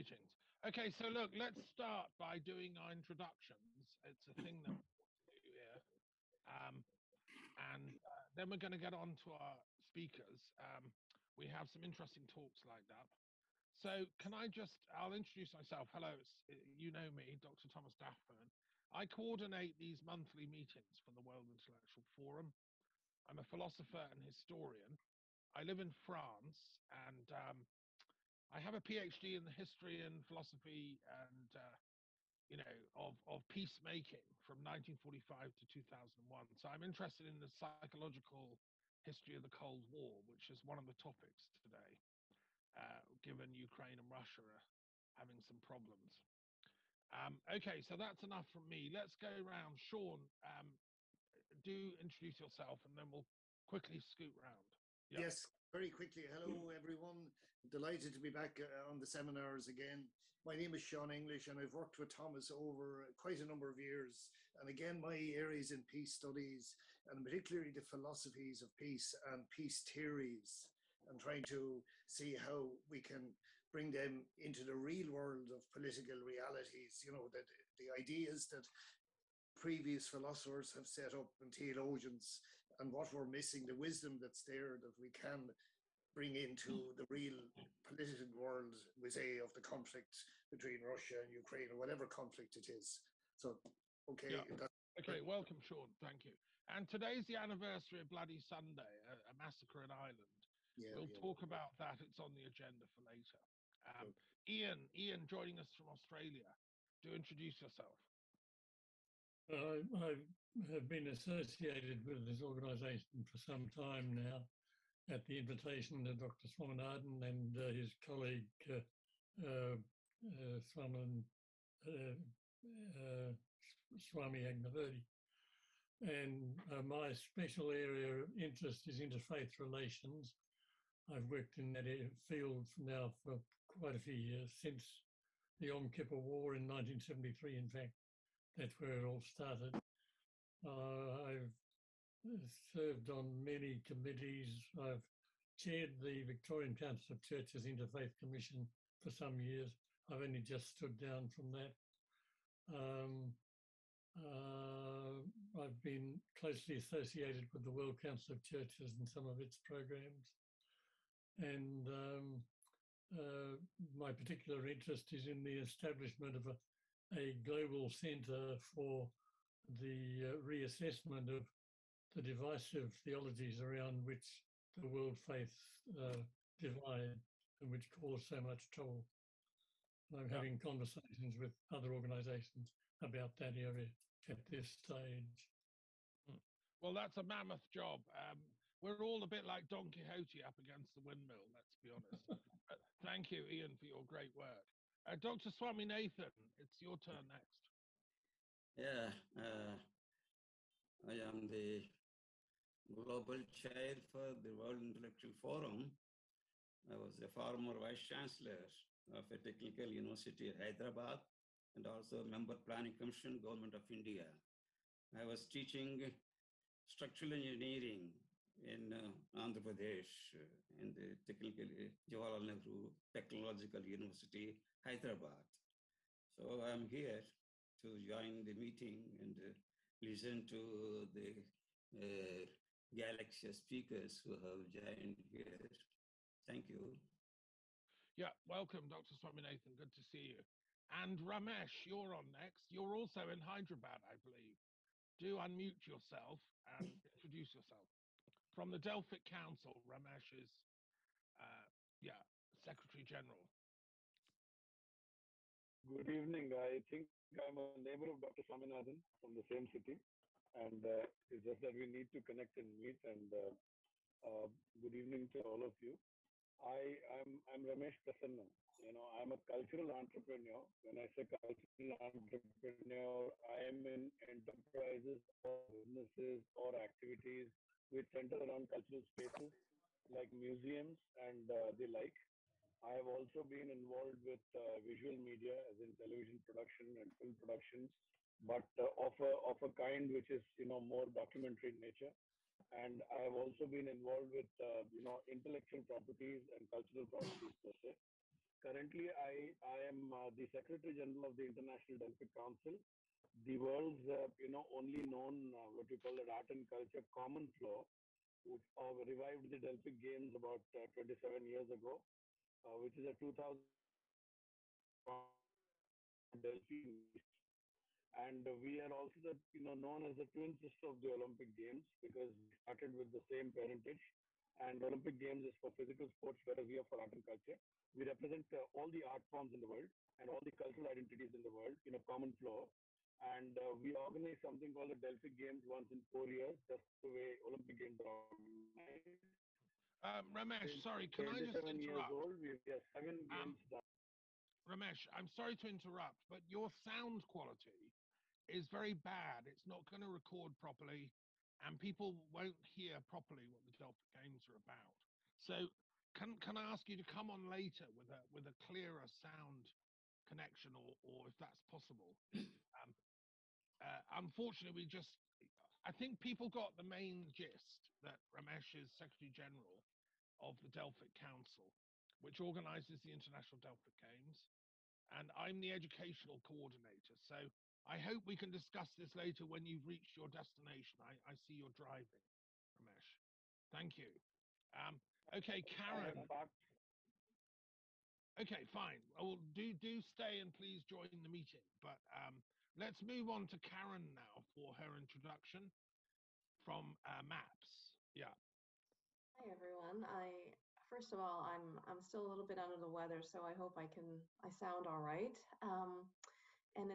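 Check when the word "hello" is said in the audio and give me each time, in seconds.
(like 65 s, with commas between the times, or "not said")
15 s, 56 s.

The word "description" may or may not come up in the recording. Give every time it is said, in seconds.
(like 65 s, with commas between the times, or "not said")
not said.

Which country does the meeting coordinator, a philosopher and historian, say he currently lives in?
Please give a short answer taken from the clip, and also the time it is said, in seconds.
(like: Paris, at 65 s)
France, at 26 s.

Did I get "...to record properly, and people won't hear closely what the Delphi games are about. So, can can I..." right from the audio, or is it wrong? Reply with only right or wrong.
wrong.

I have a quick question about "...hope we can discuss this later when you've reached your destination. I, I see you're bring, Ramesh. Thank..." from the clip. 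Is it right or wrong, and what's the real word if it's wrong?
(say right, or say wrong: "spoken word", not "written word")
wrong: "driving", not "bring".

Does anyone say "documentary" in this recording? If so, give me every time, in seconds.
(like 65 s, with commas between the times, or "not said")
291 s.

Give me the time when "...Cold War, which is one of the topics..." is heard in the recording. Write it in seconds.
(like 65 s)
39 s.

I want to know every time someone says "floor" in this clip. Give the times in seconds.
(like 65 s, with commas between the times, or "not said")
307 s, 332 s.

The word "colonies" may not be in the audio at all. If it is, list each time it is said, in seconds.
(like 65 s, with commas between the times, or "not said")
not said.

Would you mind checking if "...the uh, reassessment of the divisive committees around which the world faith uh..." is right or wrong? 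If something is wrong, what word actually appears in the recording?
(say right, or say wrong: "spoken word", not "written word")
wrong: "theologies", not "committees".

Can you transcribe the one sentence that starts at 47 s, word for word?
Um, okay, so that's enough from me.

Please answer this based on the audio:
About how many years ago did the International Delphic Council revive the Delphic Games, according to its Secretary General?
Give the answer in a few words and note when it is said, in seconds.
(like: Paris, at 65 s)
27, at 310 s.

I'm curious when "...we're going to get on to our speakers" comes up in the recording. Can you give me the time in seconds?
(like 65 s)
8 s.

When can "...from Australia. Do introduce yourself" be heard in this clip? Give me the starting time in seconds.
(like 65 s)
105 s.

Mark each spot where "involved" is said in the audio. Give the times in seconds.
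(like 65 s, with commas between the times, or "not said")
283 s, 293 s.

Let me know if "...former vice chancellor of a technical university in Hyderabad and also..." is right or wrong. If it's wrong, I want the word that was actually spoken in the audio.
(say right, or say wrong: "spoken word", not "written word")
right.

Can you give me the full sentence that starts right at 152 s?
Um, uh, I've been closely associated with the World Council of Churches and some of its programs.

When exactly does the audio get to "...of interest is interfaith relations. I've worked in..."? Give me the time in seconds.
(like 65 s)
128 s.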